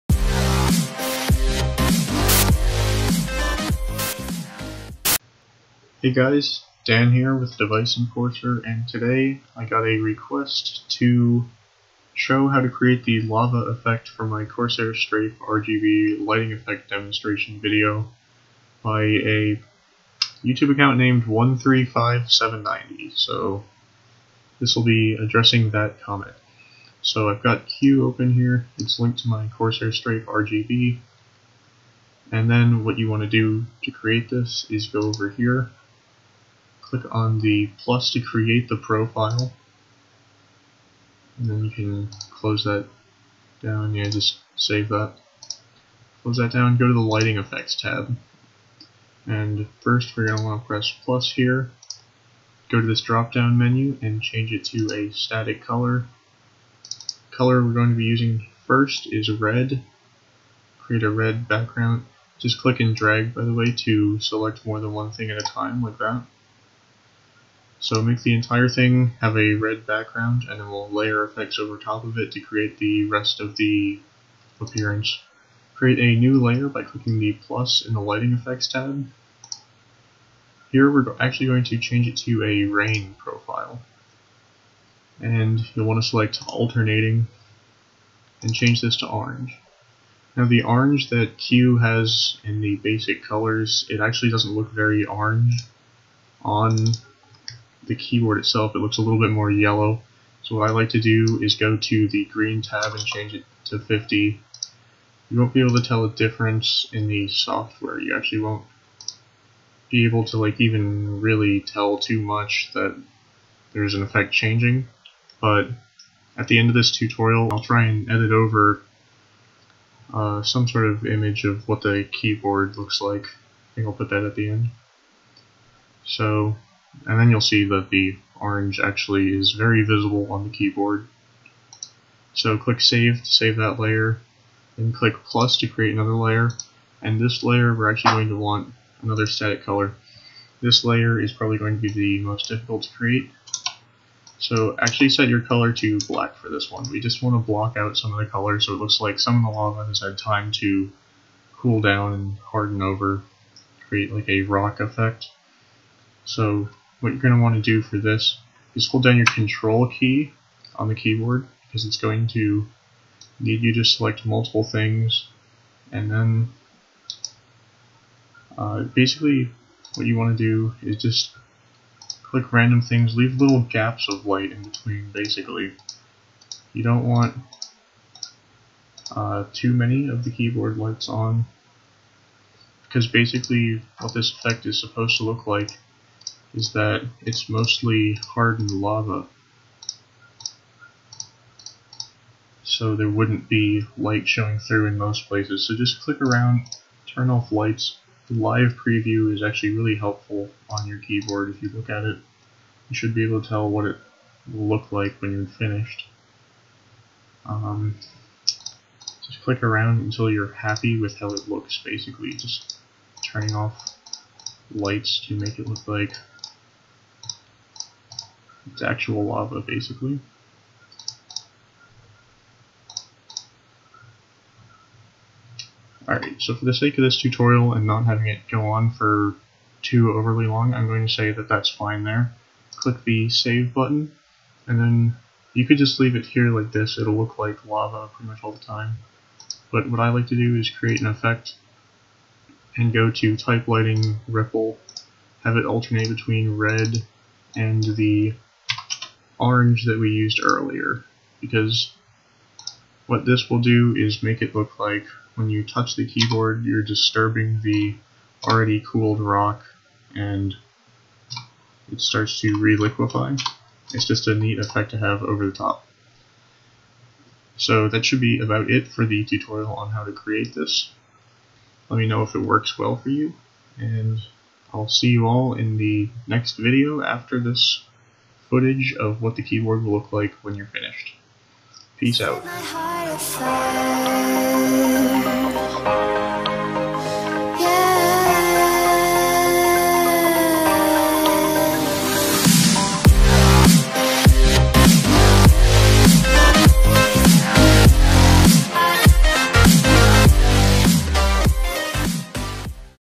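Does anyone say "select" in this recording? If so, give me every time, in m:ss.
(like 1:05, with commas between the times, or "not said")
1:04, 1:26, 2:43.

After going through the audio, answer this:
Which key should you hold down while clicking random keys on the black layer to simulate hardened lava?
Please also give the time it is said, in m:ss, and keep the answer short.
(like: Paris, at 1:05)
Control, at 2:39.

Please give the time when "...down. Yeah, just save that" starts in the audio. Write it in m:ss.
0:43.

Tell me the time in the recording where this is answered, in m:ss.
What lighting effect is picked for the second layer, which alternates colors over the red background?
1:22.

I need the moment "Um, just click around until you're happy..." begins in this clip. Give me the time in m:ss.
3:27.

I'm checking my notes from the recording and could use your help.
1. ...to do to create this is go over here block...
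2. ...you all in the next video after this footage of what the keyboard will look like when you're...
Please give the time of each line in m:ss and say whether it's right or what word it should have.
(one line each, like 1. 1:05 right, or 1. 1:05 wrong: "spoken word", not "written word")
1. 0:33 wrong: "click", not "block"
2. 4:35 right.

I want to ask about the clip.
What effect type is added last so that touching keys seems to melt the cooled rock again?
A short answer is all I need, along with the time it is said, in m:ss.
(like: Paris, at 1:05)
Type lighting ripple, at 4:03.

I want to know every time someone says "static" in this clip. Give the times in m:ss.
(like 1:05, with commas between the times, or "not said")
0:55, 2:19.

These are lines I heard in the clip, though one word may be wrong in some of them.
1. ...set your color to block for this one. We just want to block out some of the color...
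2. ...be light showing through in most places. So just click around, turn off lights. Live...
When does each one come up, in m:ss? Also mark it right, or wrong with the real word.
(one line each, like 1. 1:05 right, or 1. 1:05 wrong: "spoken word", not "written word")
1. 2:25 wrong: "black", not "block"
2. 3:13 right.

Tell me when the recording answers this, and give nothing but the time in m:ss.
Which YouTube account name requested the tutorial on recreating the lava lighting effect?
0:21.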